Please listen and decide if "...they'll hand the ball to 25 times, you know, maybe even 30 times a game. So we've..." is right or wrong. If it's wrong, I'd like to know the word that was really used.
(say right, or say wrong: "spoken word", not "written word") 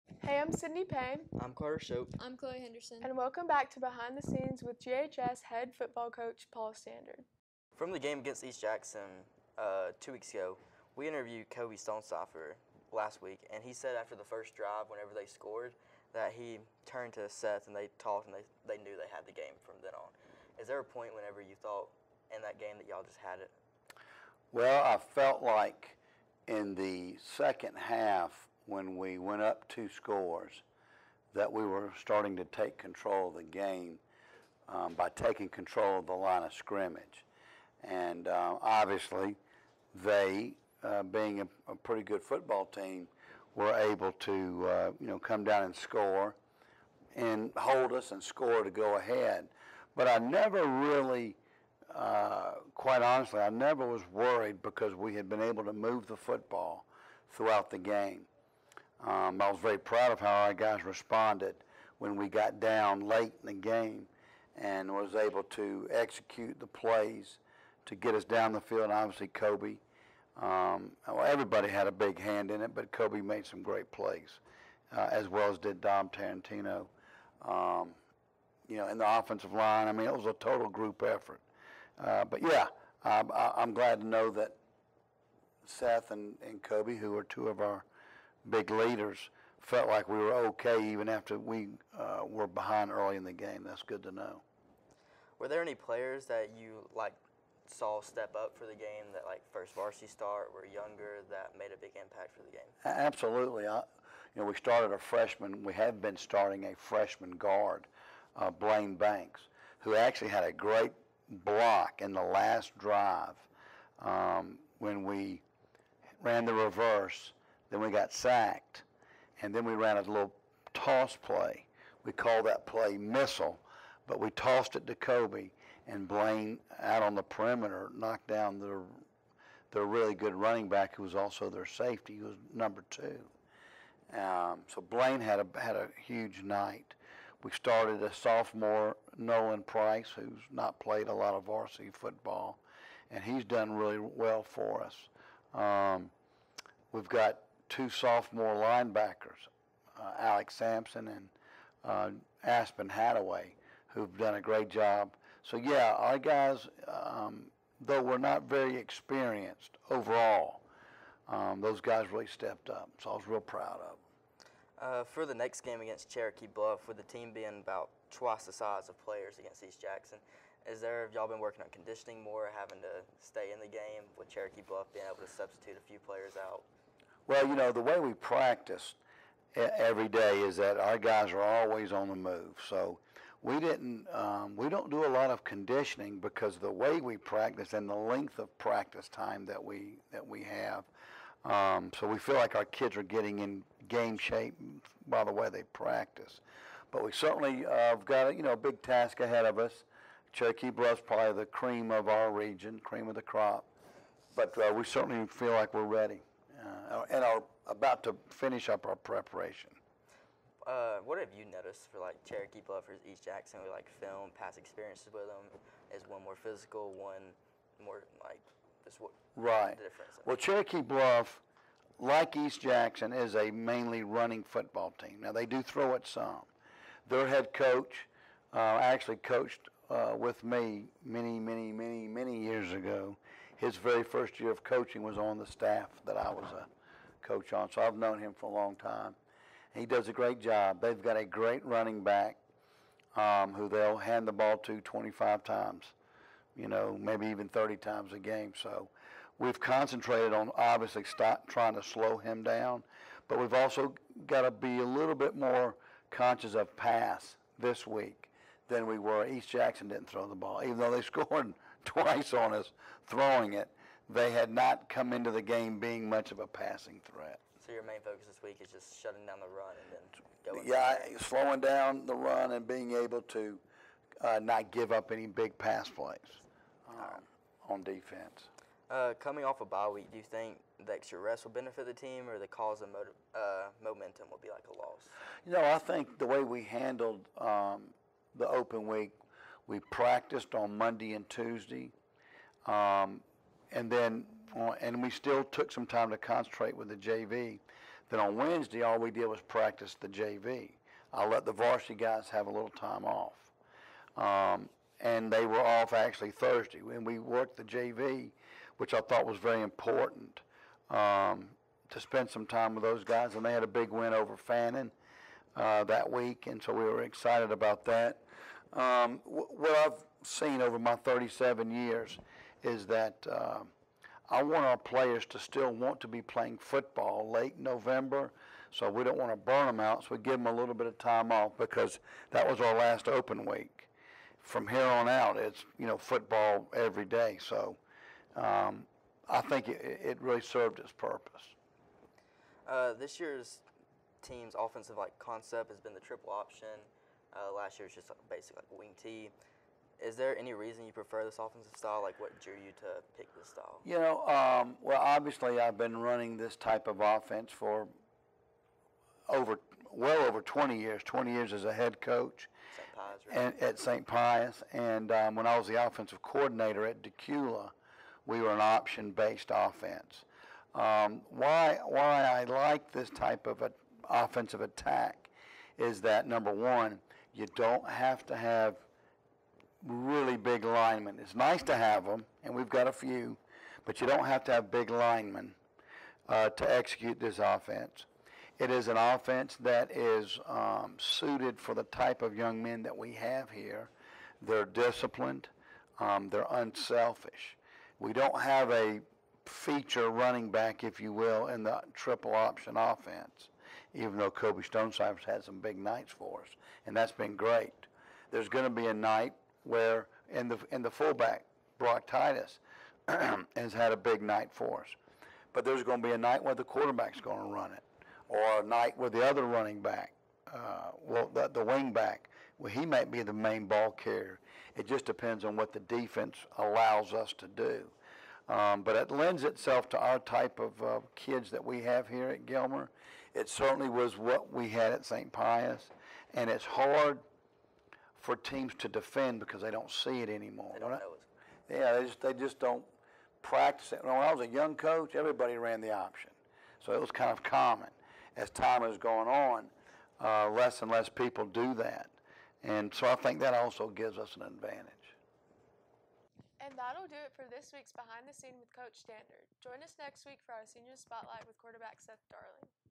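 right.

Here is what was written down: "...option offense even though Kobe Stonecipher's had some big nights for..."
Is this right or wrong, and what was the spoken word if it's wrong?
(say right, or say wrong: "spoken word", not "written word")
right.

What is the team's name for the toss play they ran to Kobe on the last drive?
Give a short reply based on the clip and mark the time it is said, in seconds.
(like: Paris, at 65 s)
missile, at 122 s.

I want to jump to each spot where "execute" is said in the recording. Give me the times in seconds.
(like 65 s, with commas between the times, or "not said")
65 s, 386 s.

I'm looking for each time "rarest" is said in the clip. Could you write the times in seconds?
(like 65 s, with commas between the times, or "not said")
not said.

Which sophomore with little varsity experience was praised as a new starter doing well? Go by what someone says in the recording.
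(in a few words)
Nolan Price.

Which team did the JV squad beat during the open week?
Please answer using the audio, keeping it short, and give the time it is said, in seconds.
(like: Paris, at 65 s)
Fannin, at 314 s.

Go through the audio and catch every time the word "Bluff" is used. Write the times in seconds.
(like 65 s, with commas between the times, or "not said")
166 s, 174 s, 200 s, 220 s.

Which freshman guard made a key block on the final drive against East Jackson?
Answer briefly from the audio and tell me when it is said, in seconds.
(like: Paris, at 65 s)
Blaine Banks, at 108 s.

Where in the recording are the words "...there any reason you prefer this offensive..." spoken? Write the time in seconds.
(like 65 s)
350 s.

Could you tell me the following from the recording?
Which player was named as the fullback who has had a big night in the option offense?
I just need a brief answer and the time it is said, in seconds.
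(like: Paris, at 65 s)
Brock Titus, at 411 s.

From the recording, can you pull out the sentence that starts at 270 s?
Yeah, slowing down the run and being able to uh, not give up any big pass plays um, on defense.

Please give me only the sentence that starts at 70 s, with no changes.
Um, well, everybody had a big hand in it, but Kobe made some great plays, uh, as well as did Dom Tarantino.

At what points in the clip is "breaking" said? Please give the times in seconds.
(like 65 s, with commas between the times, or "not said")
not said.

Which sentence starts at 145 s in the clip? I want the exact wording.
Um, we've got two sophomore linebackers, uh, Alex Sampson and uh, Aspen Hathaway, who've done a great job.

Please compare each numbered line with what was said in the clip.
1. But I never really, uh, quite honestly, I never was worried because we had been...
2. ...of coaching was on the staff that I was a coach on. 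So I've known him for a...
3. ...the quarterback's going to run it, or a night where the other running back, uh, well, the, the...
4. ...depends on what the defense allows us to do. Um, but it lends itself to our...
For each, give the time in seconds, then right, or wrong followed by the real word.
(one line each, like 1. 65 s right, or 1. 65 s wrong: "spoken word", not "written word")
1. 49 s right
2. 234 s right
3. 416 s right
4. 425 s right.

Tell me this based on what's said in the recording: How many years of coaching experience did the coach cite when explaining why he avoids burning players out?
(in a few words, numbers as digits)
37.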